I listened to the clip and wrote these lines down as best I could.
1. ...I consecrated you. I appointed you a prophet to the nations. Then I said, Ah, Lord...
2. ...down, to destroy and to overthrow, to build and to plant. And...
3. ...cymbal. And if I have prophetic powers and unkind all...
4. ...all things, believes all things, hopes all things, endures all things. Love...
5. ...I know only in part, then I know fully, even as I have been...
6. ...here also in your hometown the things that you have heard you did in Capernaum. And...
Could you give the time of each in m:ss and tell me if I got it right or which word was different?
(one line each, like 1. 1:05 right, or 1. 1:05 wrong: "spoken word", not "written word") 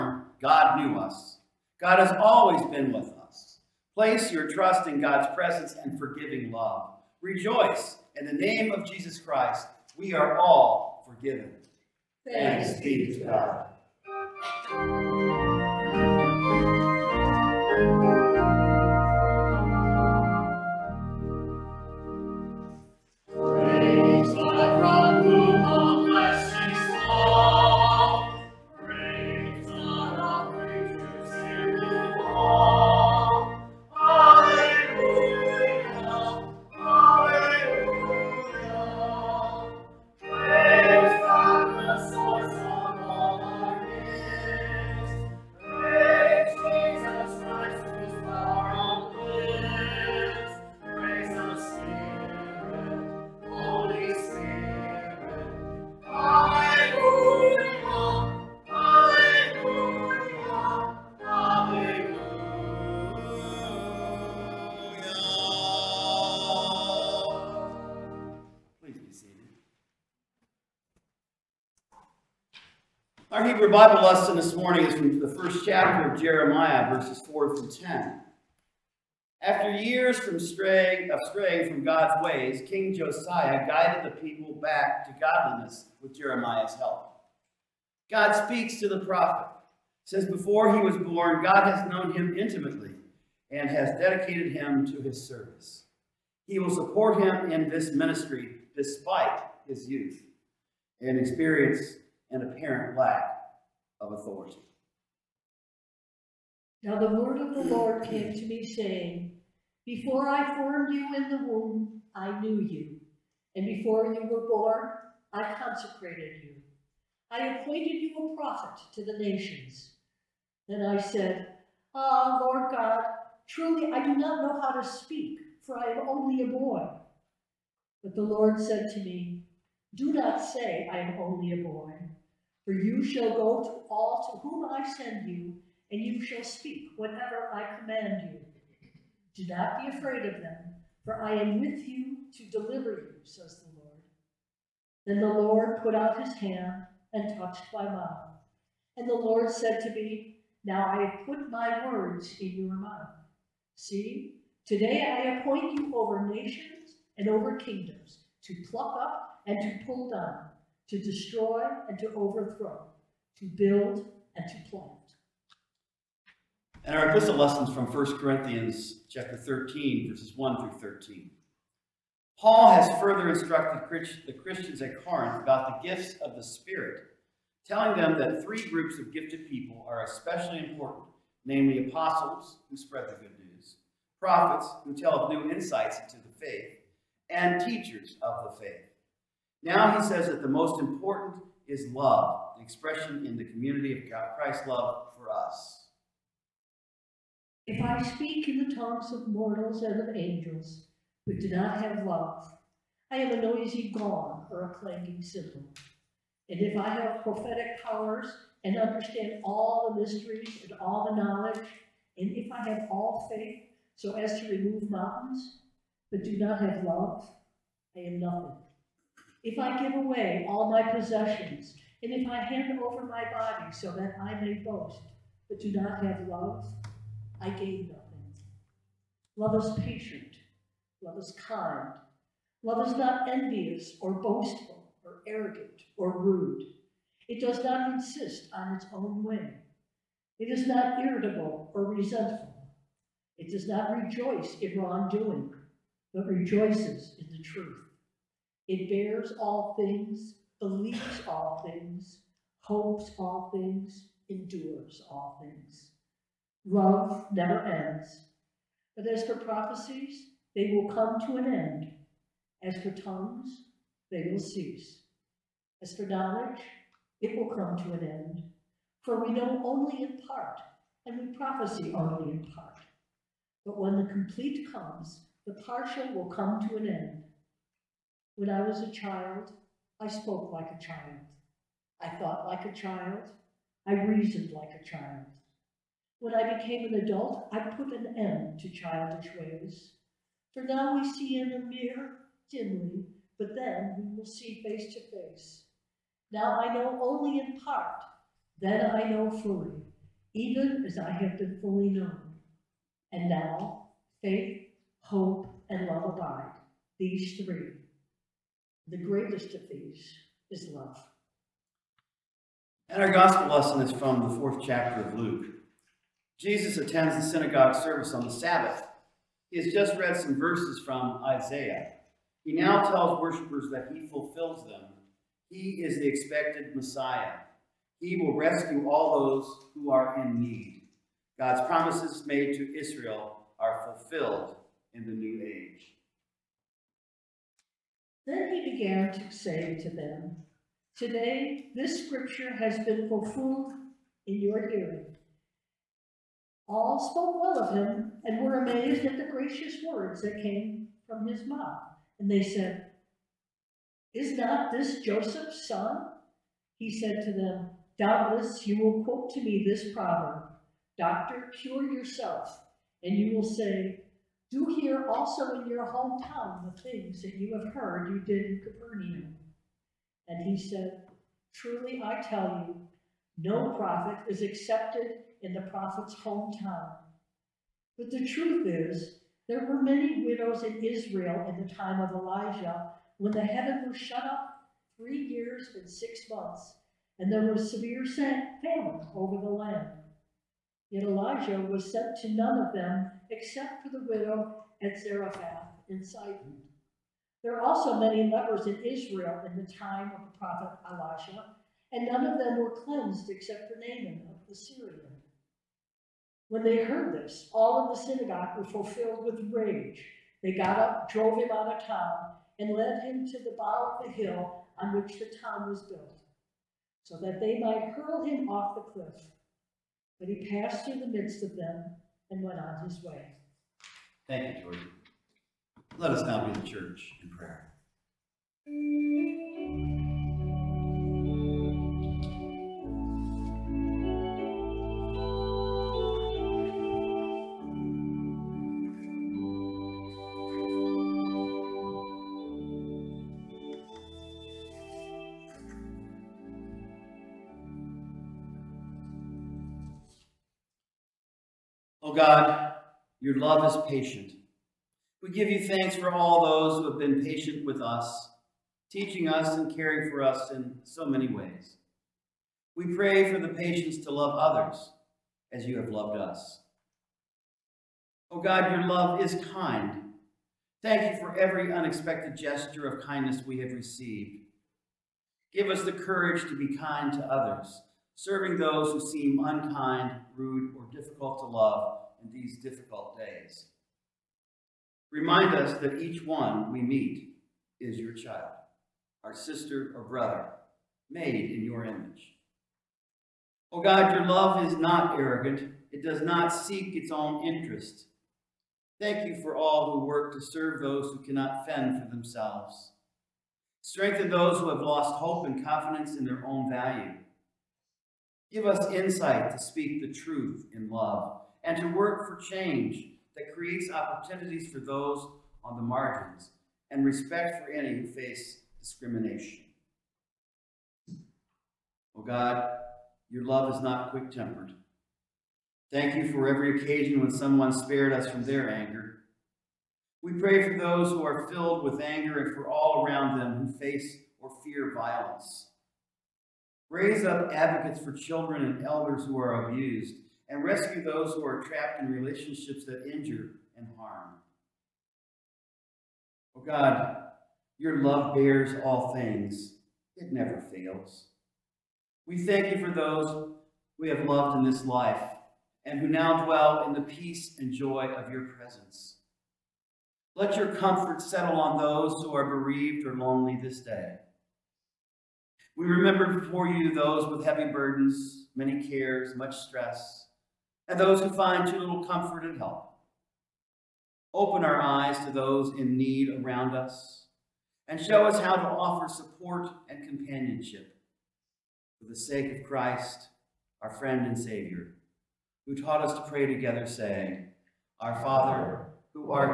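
1. 1:55 right
2. 2:40 right
3. 3:25 wrong: "understand", not "unkind"
4. 4:09 right
5. 4:56 right
6. 6:04 right.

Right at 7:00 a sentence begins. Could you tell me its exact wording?
But he passed through the midst of them and went on his way.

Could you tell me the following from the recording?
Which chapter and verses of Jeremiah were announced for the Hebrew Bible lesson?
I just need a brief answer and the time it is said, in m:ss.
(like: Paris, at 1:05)
Chapter 1, verses 4-10, at 1:16.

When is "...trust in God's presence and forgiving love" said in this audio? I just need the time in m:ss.
0:04.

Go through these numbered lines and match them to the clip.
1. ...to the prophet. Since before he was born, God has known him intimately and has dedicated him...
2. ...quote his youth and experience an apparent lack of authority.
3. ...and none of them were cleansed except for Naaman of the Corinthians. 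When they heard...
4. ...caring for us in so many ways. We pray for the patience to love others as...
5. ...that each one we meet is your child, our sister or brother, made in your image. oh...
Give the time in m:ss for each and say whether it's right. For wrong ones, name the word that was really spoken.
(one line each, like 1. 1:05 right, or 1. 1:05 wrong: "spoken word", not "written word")
1. 1:28 right
2. 1:38 wrong: "despite", not "quote"
3. 6:41 wrong: "Syrian", not "Corinthians"
4. 7:39 right
5. 8:05 right.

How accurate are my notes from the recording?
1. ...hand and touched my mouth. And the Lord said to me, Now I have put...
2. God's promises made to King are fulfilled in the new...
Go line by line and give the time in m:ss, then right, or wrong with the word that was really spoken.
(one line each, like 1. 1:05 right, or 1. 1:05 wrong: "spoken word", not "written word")
1. 2:26 right
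2. 5:31 wrong: "Israel", not "King".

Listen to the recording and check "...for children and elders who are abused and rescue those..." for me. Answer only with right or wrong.
right.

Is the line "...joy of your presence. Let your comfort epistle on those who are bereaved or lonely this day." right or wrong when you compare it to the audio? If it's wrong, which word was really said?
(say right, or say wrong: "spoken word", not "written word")
wrong: "settle", not "epistle".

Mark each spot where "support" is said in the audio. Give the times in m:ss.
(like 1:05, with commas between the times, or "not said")
1:36, 9:39.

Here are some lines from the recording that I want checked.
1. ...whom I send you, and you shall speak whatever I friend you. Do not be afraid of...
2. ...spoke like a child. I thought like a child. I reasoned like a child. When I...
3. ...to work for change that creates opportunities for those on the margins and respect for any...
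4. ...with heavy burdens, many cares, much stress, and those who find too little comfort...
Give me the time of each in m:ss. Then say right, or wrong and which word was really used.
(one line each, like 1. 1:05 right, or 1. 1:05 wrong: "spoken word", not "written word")
1. 2:14 wrong: "command", not "friend"
2. 4:40 right
3. 8:31 right
4. 9:27 right.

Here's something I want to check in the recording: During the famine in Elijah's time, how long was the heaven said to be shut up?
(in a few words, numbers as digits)
3 years and 6 months.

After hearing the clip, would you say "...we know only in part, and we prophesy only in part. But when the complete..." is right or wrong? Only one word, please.
right.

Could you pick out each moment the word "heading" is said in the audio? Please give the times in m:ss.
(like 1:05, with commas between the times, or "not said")
not said.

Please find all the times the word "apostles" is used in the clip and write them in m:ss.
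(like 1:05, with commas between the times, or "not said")
3:01.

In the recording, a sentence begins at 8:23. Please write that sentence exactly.
Strengthen those who have lost hope and confidence in their own value.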